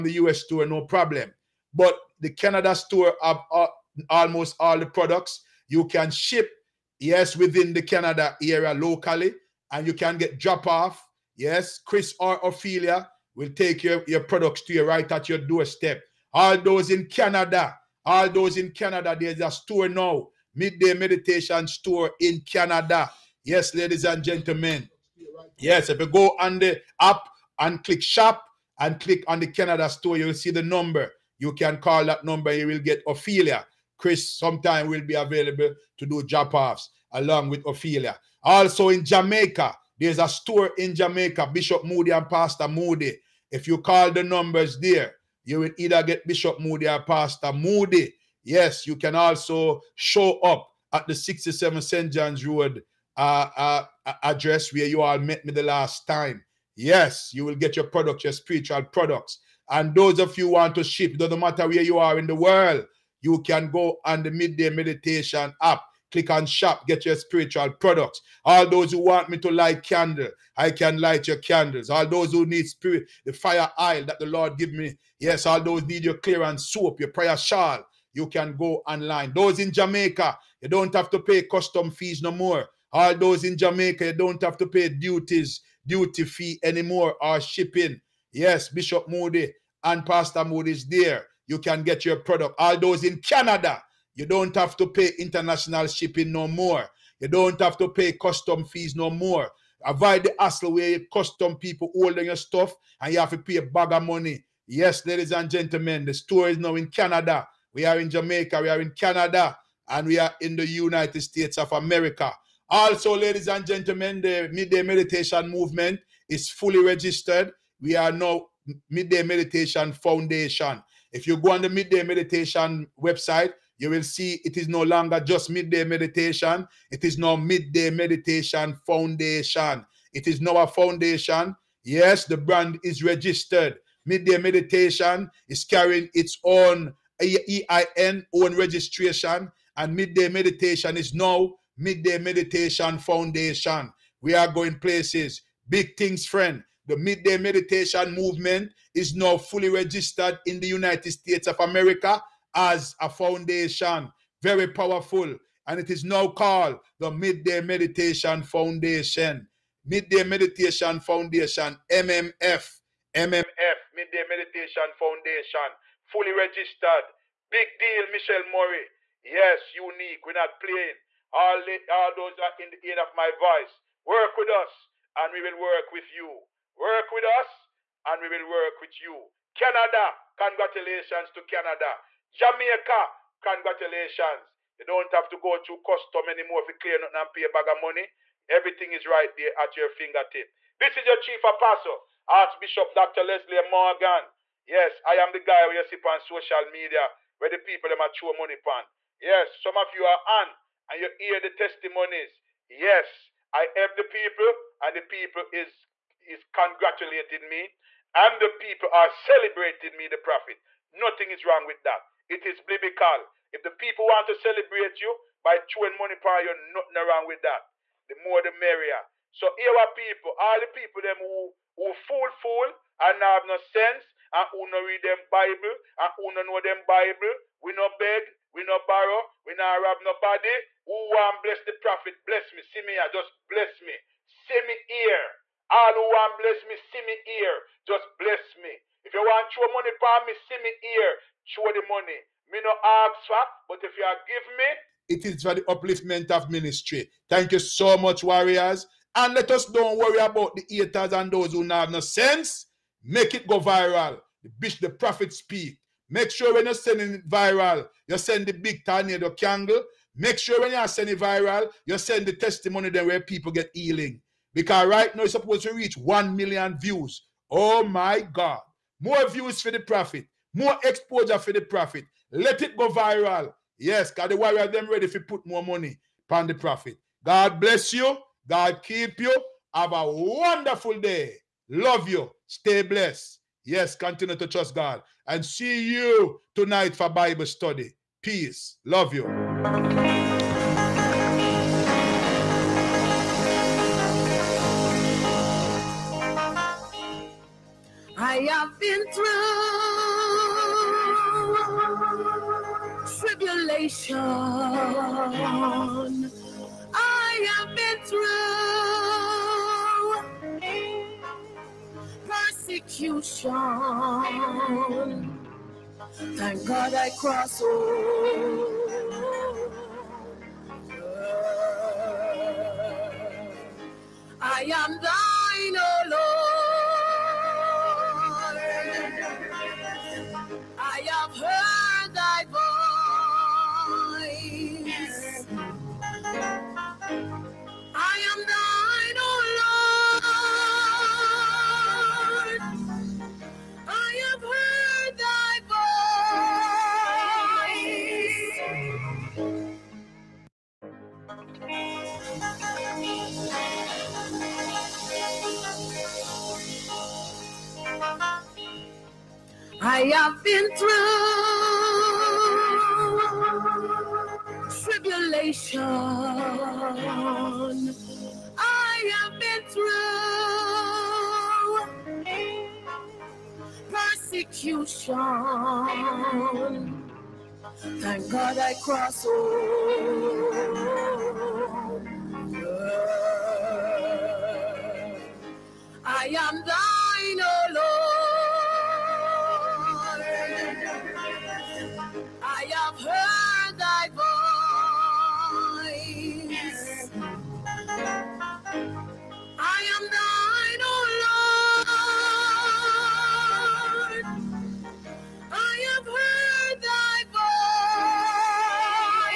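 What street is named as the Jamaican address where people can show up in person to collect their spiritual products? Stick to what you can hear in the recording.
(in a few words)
St. John's Road.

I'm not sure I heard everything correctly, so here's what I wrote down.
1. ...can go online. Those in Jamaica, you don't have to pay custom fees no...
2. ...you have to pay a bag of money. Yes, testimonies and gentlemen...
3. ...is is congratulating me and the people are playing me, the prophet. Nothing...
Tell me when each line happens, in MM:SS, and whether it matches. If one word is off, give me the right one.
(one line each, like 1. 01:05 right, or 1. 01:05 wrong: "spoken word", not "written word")
1. 01:18 right
2. 01:43 wrong: "ladies", not "testimonies"
3. 03:25 wrong: "celebrating", not "playing".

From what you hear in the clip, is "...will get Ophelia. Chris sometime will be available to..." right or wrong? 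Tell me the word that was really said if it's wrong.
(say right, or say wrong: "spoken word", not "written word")
right.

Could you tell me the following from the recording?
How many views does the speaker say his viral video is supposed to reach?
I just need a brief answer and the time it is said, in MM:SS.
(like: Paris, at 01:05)
1 million, at 04:25.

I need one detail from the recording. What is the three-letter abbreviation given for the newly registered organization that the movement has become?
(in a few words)
MMF.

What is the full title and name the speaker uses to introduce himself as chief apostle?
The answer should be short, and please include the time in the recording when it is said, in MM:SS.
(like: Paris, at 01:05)
Archbishop Dr. Leslie Morgan, at 03:12.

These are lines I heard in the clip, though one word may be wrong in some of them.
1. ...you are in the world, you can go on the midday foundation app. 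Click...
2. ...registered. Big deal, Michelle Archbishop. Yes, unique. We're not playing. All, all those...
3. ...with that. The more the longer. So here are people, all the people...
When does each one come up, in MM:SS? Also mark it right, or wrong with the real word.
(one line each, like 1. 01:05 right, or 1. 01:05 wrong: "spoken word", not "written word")
1. 01:01 wrong: "meditation", not "foundation"
2. 02:46 wrong: "Murray", not "Archbishop"
3. 03:37 wrong: "merrier", not "longer".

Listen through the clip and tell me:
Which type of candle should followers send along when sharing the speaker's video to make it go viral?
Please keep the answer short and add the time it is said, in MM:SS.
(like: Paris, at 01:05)
big tornado candle, at 04:18.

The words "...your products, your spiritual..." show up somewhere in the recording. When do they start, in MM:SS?
00:57.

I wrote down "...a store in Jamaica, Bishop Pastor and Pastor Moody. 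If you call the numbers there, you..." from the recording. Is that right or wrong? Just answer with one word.
wrong.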